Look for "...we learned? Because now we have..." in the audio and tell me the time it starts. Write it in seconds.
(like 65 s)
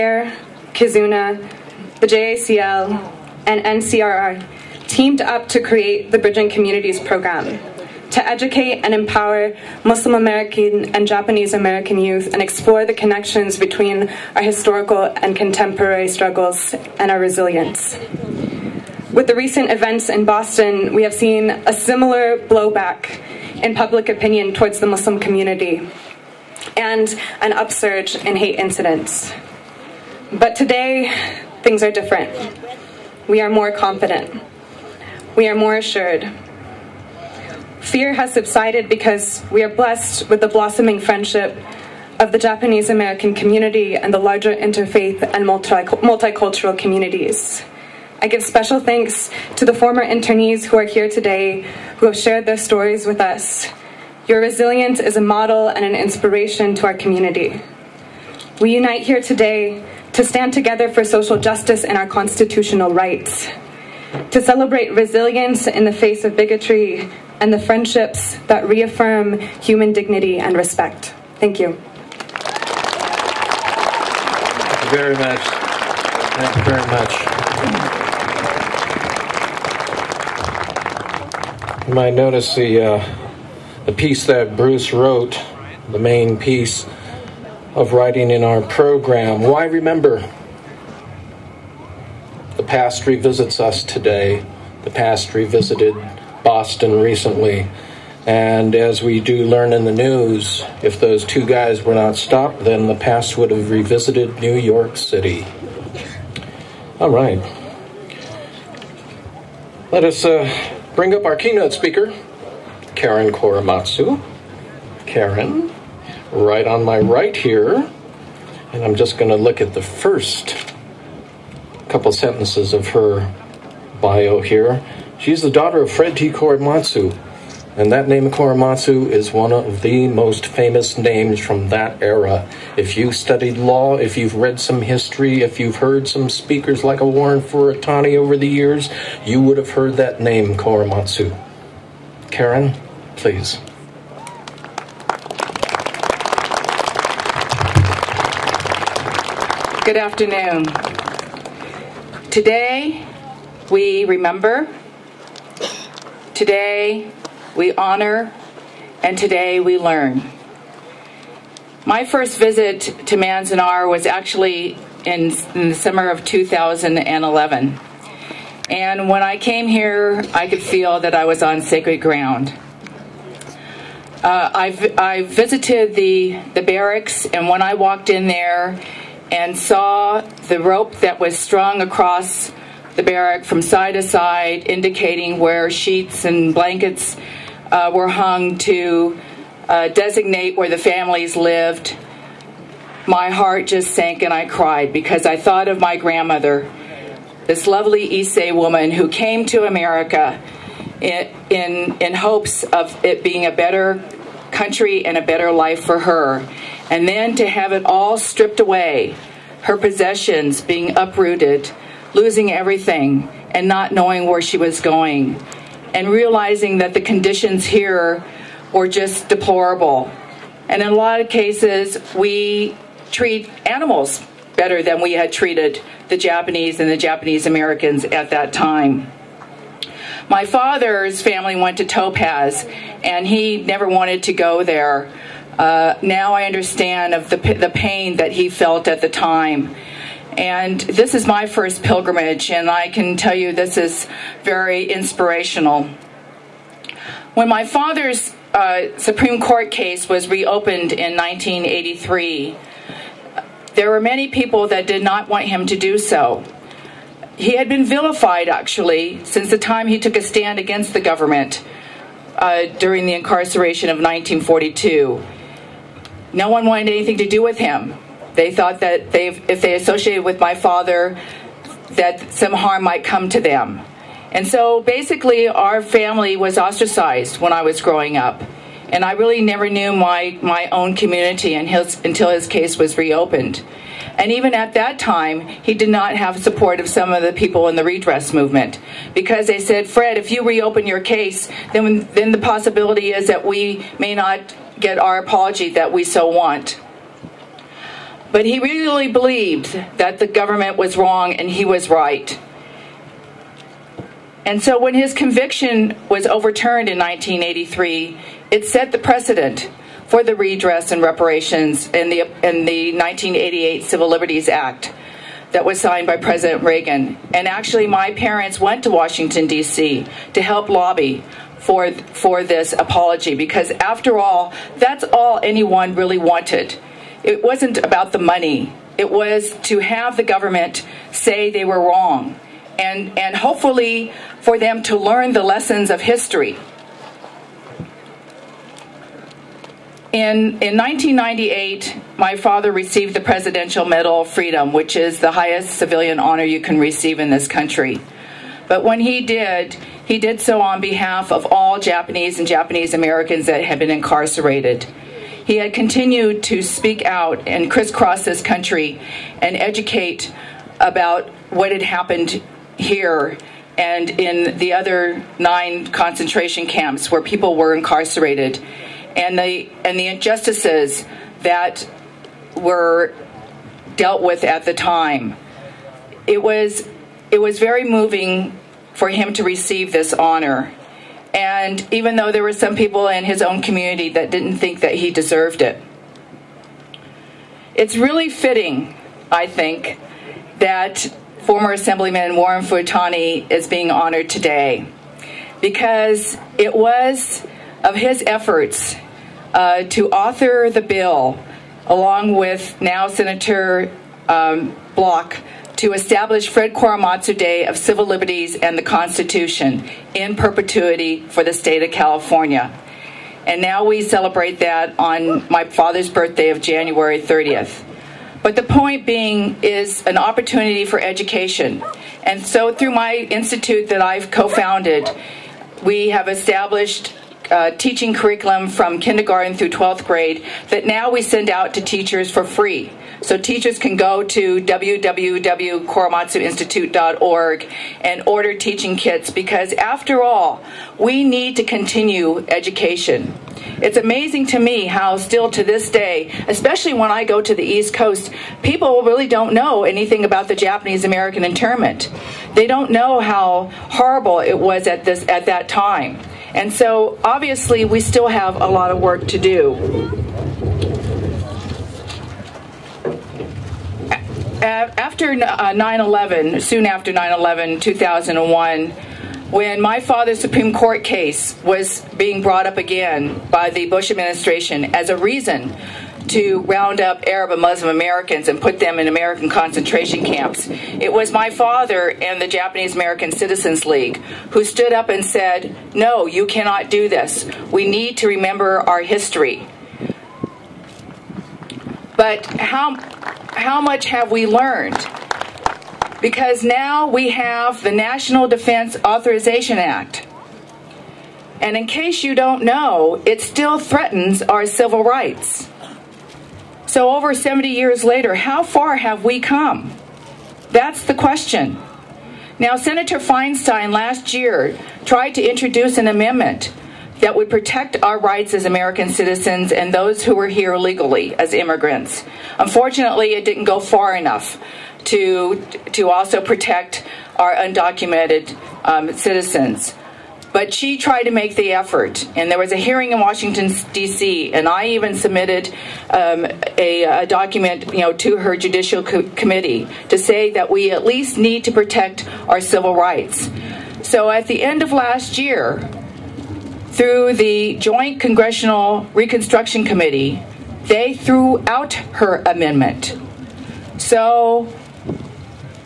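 494 s.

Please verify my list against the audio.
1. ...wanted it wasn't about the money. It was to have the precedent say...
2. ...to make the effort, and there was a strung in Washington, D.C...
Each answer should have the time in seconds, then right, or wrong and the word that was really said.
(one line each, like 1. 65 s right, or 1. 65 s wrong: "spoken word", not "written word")
1. 326 s wrong: "government", not "precedent"
2. 531 s wrong: "hearing", not "strung".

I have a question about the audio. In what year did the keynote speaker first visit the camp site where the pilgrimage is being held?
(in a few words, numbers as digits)
2011.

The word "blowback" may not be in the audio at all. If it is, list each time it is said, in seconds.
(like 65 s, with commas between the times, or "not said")
22 s.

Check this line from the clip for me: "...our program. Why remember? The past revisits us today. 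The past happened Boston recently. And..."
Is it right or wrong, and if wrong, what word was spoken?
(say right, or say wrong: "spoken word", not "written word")
wrong: "revisited", not "happened".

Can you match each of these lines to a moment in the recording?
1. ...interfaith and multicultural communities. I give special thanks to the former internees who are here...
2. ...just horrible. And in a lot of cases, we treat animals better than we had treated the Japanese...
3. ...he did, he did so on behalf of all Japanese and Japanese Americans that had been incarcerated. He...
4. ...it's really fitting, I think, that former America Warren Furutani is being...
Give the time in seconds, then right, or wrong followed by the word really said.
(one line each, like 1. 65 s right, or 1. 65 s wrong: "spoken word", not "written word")
1. 44 s right
2. 218 s wrong: "deplorable", not "horrible"
3. 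349 s right
4. 387 s wrong: "Assemblyman", not "America".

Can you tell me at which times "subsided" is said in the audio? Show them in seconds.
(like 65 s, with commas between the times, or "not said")
38 s.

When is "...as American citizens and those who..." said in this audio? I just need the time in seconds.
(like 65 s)
518 s.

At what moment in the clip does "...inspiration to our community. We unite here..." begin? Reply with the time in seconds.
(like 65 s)
55 s.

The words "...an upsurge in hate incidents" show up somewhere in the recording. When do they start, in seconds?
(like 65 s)
27 s.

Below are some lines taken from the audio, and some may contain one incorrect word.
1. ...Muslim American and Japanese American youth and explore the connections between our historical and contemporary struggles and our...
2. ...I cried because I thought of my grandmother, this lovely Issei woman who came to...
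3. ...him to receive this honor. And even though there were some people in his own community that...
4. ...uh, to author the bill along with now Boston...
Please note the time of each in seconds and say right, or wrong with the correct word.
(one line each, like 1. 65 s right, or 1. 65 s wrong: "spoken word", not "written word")
1. 9 s right
2. 194 s right
3. 379 s right
4. 399 s wrong: "Senator", not "Boston".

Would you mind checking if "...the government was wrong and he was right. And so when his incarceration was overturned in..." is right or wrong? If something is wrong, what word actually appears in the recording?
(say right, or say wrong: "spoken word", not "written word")
wrong: "conviction", not "incarceration".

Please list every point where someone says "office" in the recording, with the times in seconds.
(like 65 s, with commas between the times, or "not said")
not said.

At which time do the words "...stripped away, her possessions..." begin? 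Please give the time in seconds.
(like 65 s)
208 s.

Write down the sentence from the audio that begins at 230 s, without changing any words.
My father's family went to Topaz, and he never wanted to go there.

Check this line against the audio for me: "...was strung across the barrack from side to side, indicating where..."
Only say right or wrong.
right.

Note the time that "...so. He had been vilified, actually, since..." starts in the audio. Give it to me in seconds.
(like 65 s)
255 s.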